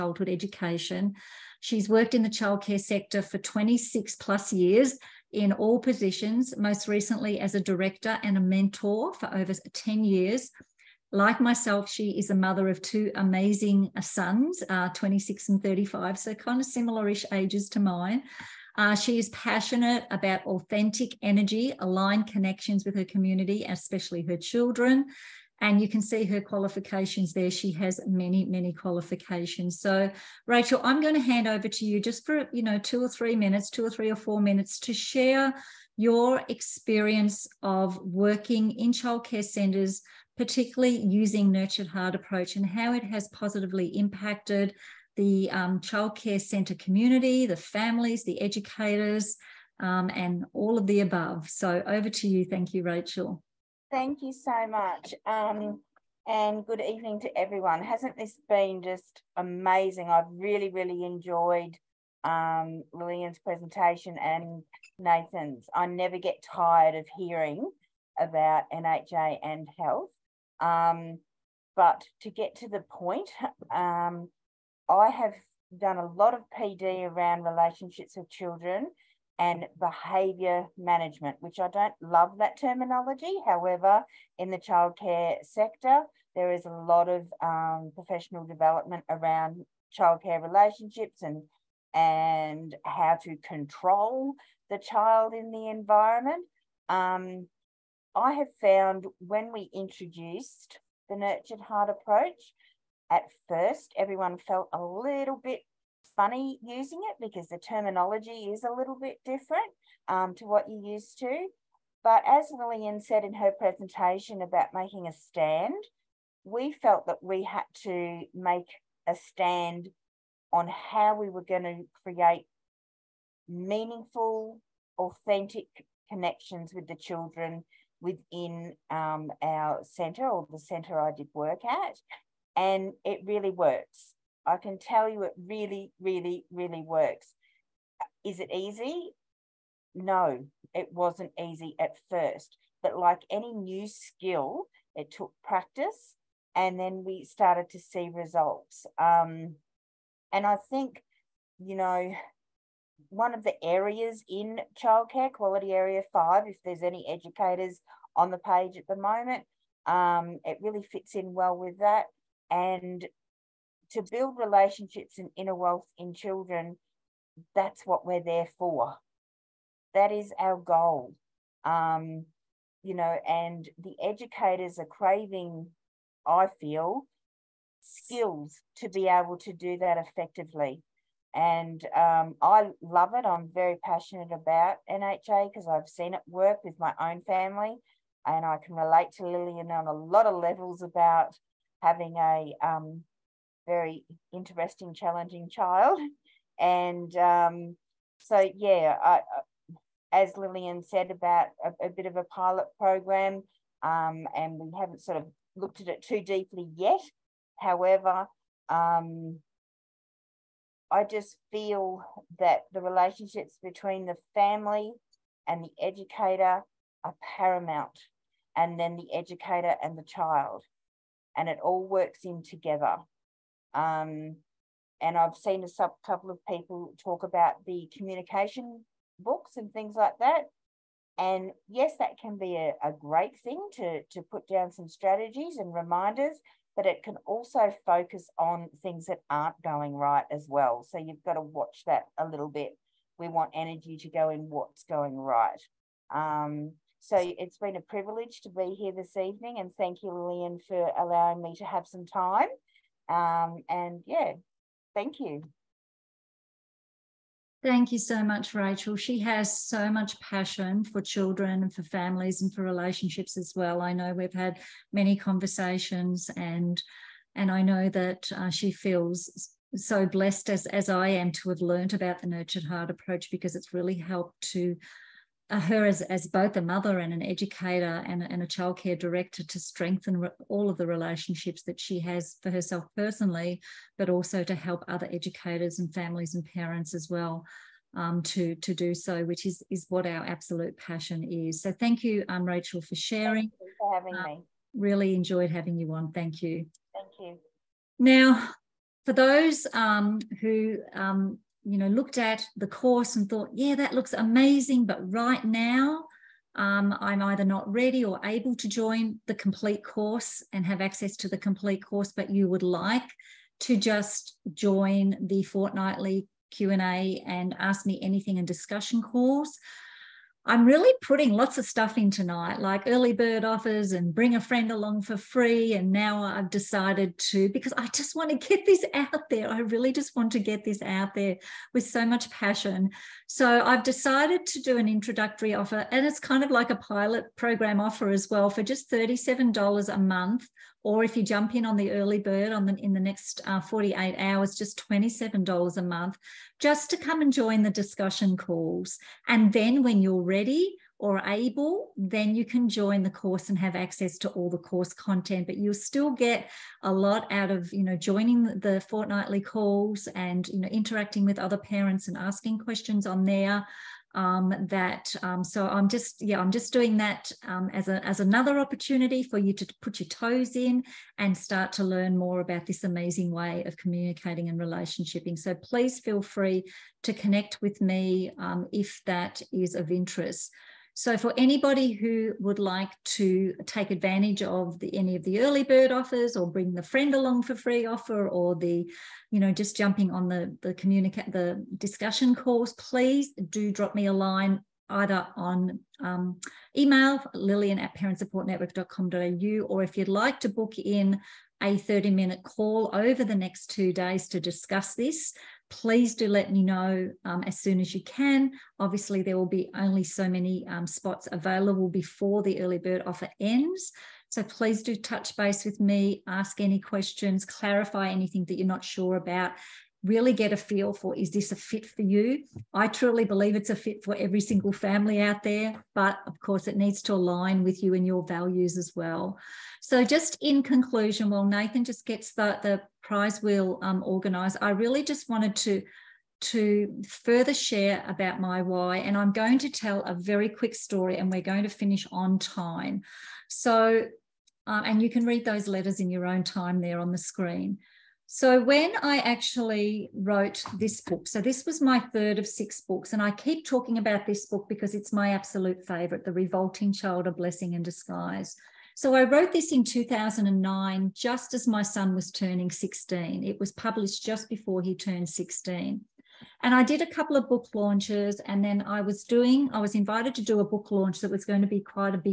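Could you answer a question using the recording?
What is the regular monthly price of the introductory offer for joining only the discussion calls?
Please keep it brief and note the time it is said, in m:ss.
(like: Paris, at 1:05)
$37 a month, at 5:38.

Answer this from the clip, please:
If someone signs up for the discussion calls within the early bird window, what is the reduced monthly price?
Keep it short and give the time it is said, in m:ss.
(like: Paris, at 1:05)
$27 a month, at 5:44.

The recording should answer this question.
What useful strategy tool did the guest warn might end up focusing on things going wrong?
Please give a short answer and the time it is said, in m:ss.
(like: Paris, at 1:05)
Communication books, at 3:47.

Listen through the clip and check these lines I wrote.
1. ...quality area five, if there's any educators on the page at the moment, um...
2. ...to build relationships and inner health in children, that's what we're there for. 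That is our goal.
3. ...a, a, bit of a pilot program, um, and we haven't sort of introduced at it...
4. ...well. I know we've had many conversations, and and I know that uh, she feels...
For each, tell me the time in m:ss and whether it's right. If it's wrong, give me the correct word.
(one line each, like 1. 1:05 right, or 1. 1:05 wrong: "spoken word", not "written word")
1. 2:35 right
2. 2:43 wrong: "wealth", not "health"
3. 3:21 wrong: "looked", not "introduced"
4. 4:23 right.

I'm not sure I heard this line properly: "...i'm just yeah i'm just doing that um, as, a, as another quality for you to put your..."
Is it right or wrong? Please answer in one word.
wrong.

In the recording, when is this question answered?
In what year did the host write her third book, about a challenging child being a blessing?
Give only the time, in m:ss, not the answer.
7:39.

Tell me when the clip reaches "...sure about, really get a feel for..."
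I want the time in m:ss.
6:58.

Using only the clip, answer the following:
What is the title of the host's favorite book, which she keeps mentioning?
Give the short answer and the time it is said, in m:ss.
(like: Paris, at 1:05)
The Revolting Child, at 7:36.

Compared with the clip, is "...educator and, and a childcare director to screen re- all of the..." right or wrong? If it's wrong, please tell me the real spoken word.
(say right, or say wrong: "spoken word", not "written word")
wrong: "strengthen", not "screen".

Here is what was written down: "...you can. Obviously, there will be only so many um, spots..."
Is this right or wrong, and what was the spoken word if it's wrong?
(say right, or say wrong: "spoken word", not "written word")
right.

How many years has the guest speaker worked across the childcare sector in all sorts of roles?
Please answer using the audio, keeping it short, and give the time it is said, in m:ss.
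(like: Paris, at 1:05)
26 plus years, at 0:03.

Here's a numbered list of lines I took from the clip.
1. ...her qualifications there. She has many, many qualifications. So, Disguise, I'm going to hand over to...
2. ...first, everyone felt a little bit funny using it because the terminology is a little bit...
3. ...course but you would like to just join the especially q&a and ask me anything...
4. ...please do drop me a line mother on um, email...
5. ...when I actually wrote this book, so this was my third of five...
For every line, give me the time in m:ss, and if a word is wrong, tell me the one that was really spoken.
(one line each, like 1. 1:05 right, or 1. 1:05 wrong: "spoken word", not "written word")
1. 0:26 wrong: "Rachel", not "Disguise"
2. 1:43 right
3. 5:11 wrong: "fortnightly", not "especially"
4. 6:32 wrong: "either", not "mother"
5. 7:28 wrong: "six", not "five".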